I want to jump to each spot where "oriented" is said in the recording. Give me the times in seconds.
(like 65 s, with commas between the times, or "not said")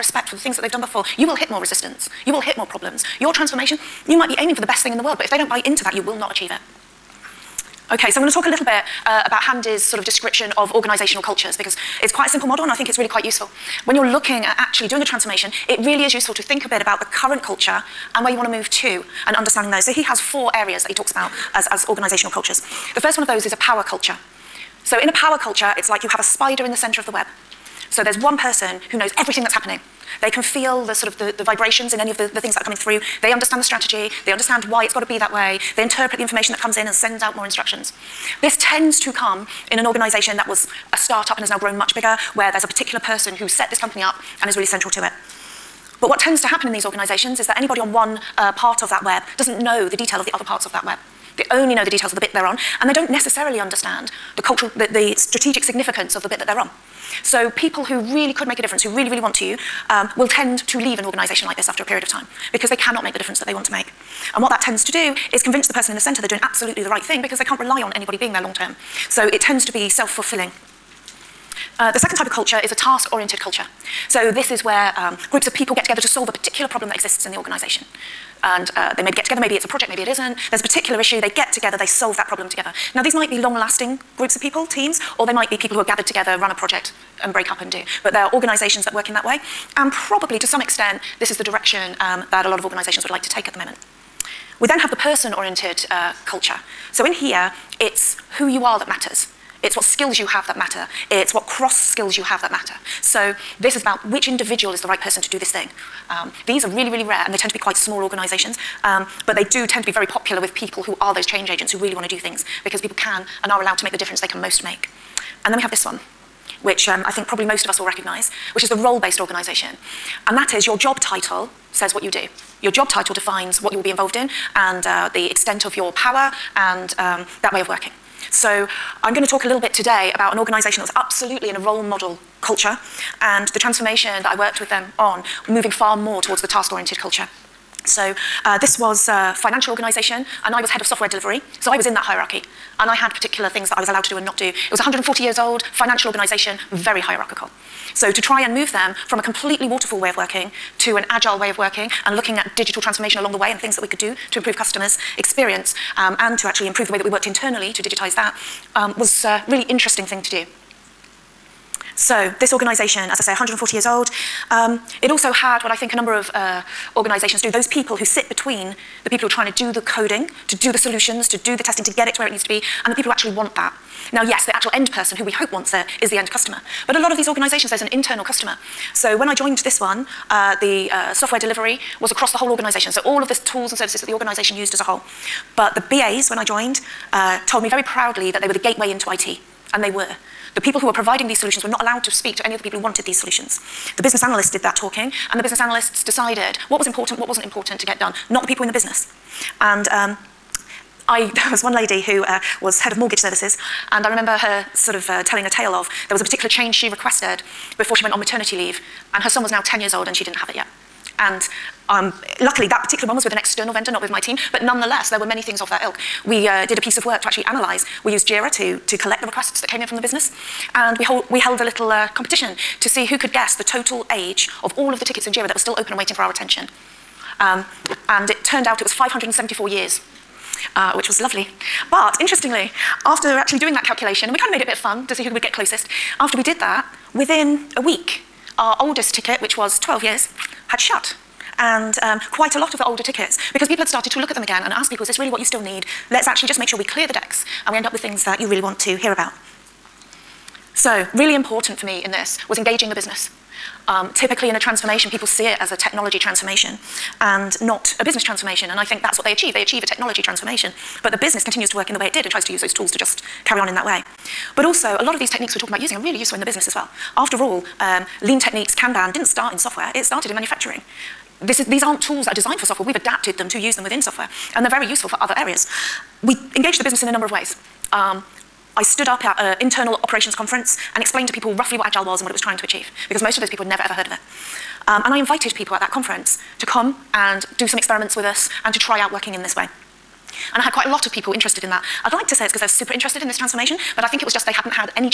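72 s, 94 s, 136 s.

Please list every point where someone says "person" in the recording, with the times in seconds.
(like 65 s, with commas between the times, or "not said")
28 s, 42 s, 65 s, 94 s, 104 s, 174 s.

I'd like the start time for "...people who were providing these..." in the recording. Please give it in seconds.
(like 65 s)
190 s.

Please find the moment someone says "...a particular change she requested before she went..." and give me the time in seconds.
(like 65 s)
206 s.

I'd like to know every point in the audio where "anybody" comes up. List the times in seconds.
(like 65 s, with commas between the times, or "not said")
47 s, 67 s.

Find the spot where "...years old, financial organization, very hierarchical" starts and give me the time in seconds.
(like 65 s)
145 s.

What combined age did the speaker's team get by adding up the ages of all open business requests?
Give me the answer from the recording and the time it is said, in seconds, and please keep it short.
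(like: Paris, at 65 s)
574 years, at 228 s.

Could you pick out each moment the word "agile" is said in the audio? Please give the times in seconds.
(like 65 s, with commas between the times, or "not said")
151 s, 281 s.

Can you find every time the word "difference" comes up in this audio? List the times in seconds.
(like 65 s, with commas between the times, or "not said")
58 s, 63 s, 113 s.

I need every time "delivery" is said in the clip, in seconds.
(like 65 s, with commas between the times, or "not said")
141 s, 181 s.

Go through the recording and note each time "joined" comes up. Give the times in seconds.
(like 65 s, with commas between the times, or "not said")
179 s, 186 s.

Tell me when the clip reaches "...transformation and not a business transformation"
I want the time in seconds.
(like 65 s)
256 s.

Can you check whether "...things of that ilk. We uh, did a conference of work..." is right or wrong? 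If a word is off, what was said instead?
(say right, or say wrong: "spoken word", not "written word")
wrong: "piece", not "conference".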